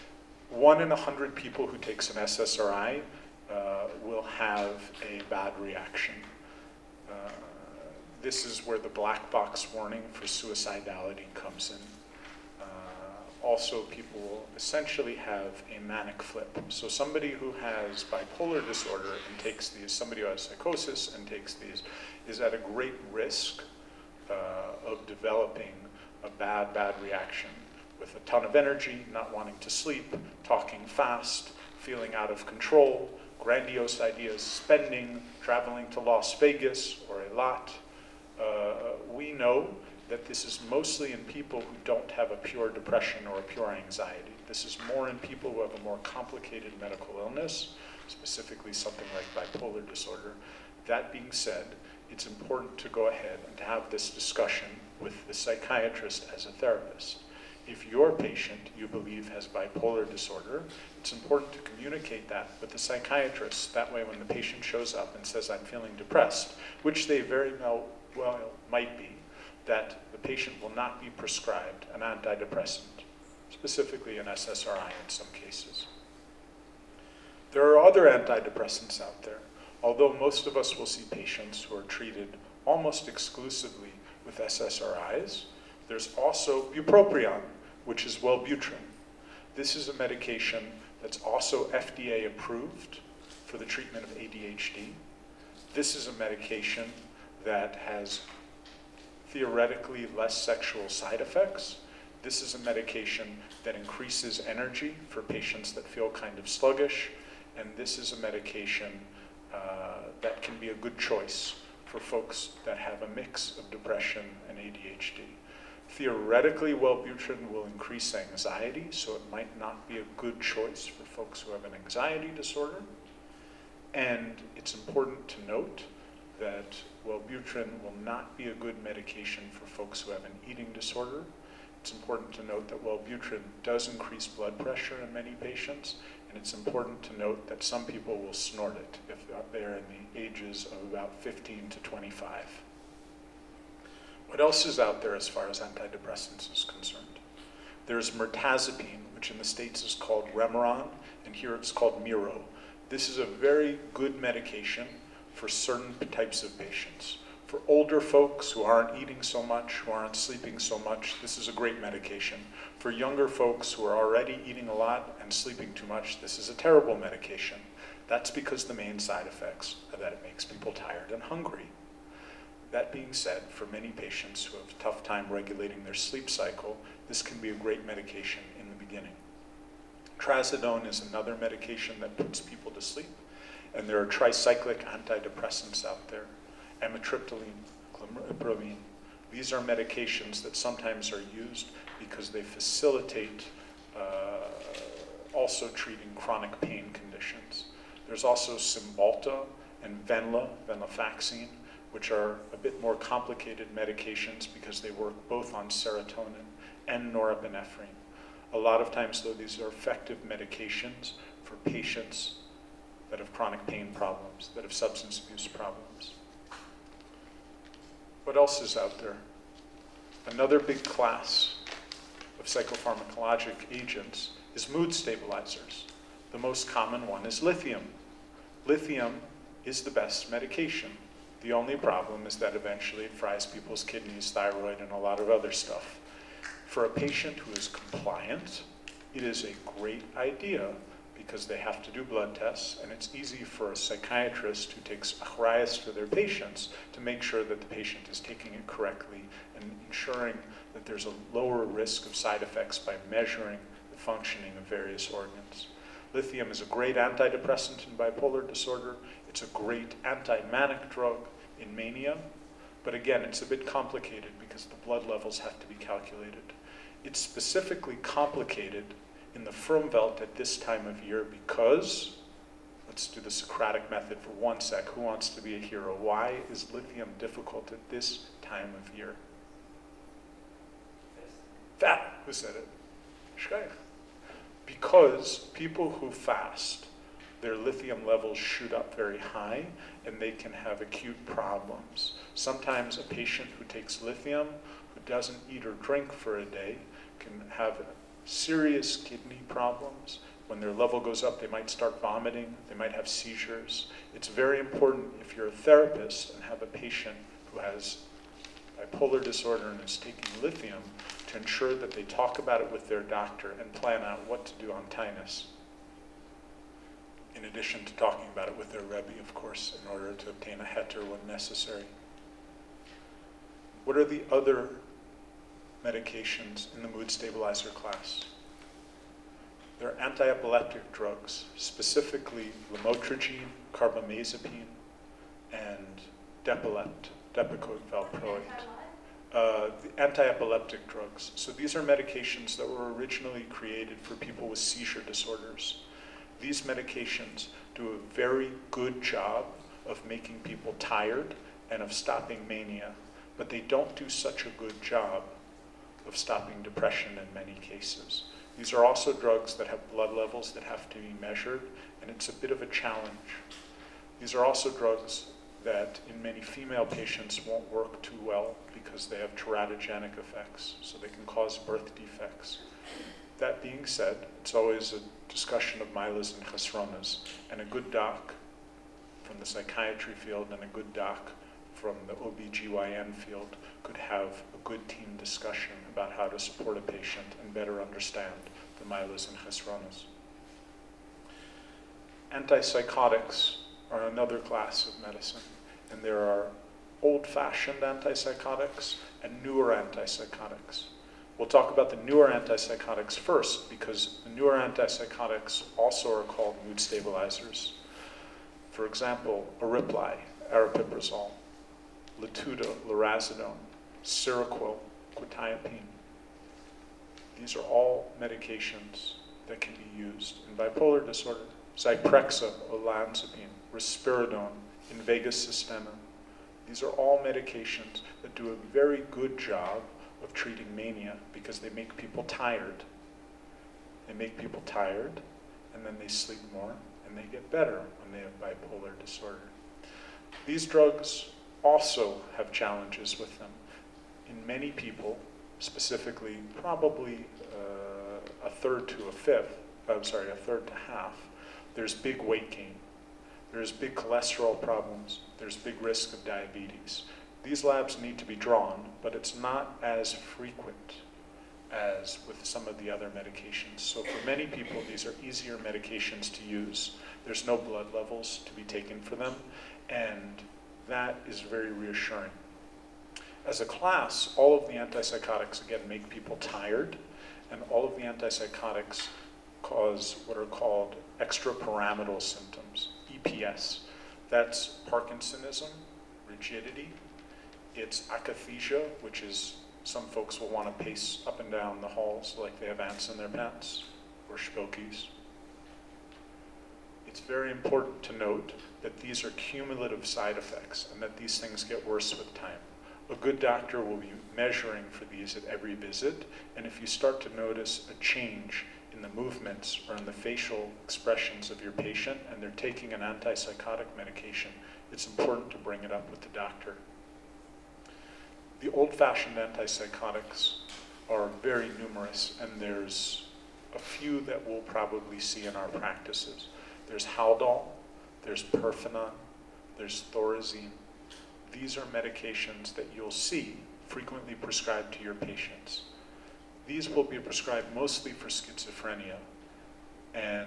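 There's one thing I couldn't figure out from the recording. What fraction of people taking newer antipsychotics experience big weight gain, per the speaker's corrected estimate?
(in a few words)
a third to half.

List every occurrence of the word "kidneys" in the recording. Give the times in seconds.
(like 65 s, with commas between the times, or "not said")
233 s, 298 s.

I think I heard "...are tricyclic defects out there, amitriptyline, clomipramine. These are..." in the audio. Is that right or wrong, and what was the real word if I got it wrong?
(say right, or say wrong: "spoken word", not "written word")
wrong: "antidepressants", not "defects".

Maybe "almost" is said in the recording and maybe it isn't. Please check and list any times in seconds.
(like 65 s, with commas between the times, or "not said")
82 s.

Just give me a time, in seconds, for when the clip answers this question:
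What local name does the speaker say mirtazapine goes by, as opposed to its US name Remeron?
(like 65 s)
152 s.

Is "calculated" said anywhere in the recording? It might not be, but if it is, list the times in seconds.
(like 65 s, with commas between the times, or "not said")
265 s.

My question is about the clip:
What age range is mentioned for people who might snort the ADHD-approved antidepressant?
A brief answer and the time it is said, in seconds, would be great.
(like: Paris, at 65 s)
15 to 25, at 141 s.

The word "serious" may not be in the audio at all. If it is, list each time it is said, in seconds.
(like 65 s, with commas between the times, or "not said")
298 s.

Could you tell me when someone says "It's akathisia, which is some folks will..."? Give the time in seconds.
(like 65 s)
487 s.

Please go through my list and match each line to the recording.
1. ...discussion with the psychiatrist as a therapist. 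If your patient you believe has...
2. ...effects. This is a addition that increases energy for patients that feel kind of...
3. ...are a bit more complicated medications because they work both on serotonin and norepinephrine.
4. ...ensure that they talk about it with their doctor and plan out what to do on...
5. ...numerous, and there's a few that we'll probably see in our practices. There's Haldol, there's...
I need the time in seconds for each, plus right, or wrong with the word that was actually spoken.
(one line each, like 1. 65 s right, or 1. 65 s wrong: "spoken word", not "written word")
1. 54 s right
2. 101 s wrong: "medication", not "addition"
3. 202 s right
4. 311 s right
5. 521 s right.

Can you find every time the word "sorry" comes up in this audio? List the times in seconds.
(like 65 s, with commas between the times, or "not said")
450 s.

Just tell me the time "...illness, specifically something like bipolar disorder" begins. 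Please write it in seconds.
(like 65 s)
47 s.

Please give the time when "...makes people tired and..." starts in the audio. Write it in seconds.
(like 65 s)
170 s.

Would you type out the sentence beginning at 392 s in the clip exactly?
Antipsychotics are another class of medicine, and there are old-fashioned antipsychotics and newer antipsychotics.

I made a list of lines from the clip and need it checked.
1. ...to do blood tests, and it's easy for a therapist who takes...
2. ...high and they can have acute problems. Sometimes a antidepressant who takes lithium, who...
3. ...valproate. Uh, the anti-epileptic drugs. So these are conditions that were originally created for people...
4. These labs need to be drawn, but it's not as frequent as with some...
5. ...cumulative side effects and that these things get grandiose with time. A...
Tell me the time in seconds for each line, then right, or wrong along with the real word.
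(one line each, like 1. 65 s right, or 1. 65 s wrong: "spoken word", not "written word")
1. 241 s wrong: "psychiatrist", not "therapist"
2. 289 s wrong: "patient", not "antidepressant"
3. 337 s wrong: "medications", not "conditions"
4. 457 s right
5. 499 s wrong: "worse", not "grandiose".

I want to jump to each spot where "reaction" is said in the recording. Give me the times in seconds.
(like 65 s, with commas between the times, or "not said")
5 s, 27 s.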